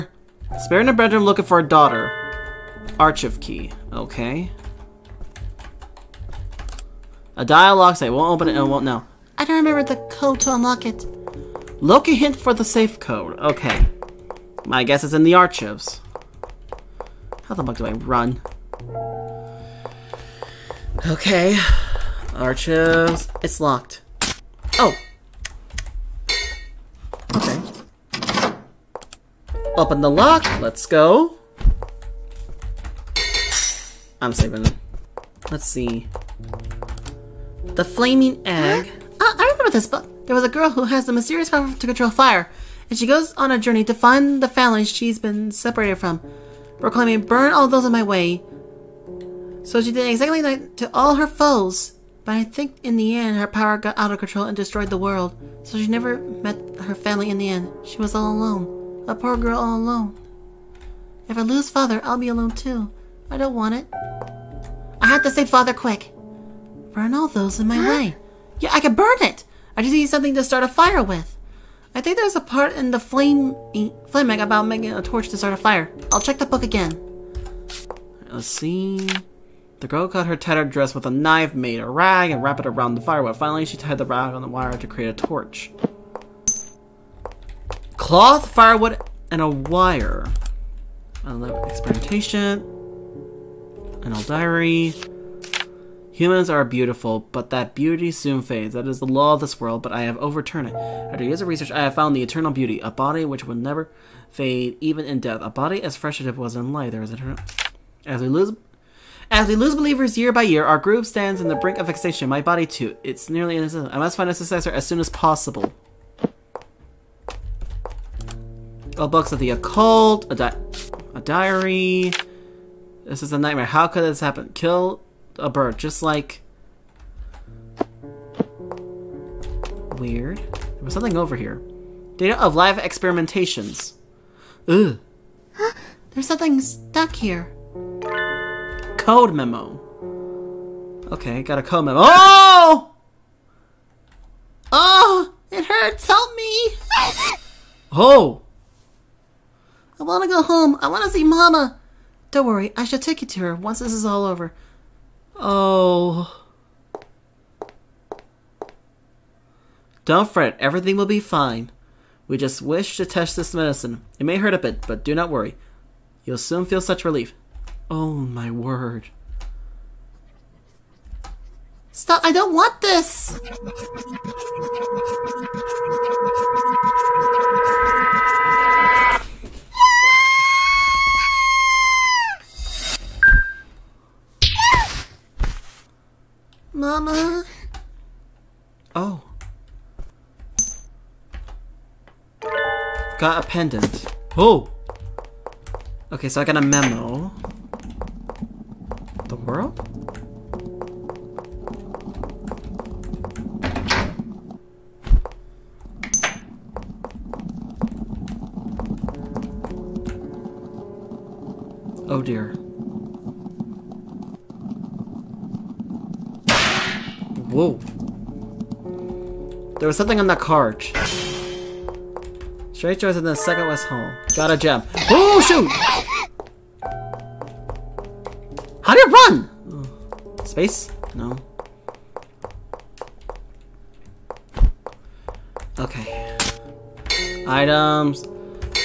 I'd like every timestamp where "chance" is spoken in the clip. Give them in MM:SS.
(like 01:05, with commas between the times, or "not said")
not said.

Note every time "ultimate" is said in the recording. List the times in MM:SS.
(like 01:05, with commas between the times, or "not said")
not said.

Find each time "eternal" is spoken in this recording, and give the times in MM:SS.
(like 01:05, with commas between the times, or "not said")
01:42, 01:47.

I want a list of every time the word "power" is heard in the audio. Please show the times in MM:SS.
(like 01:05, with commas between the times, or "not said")
00:41, 00:53.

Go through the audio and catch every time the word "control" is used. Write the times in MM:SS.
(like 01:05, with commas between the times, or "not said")
00:41, 00:54.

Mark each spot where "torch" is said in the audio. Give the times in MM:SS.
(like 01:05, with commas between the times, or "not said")
01:15, 01:25.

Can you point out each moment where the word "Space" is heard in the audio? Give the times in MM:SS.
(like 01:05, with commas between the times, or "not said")
03:50.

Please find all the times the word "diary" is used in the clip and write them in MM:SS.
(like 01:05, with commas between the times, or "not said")
01:34, 02:01.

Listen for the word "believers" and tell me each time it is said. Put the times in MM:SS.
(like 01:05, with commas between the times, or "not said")
01:49.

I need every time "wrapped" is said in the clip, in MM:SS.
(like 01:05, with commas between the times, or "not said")
01:22.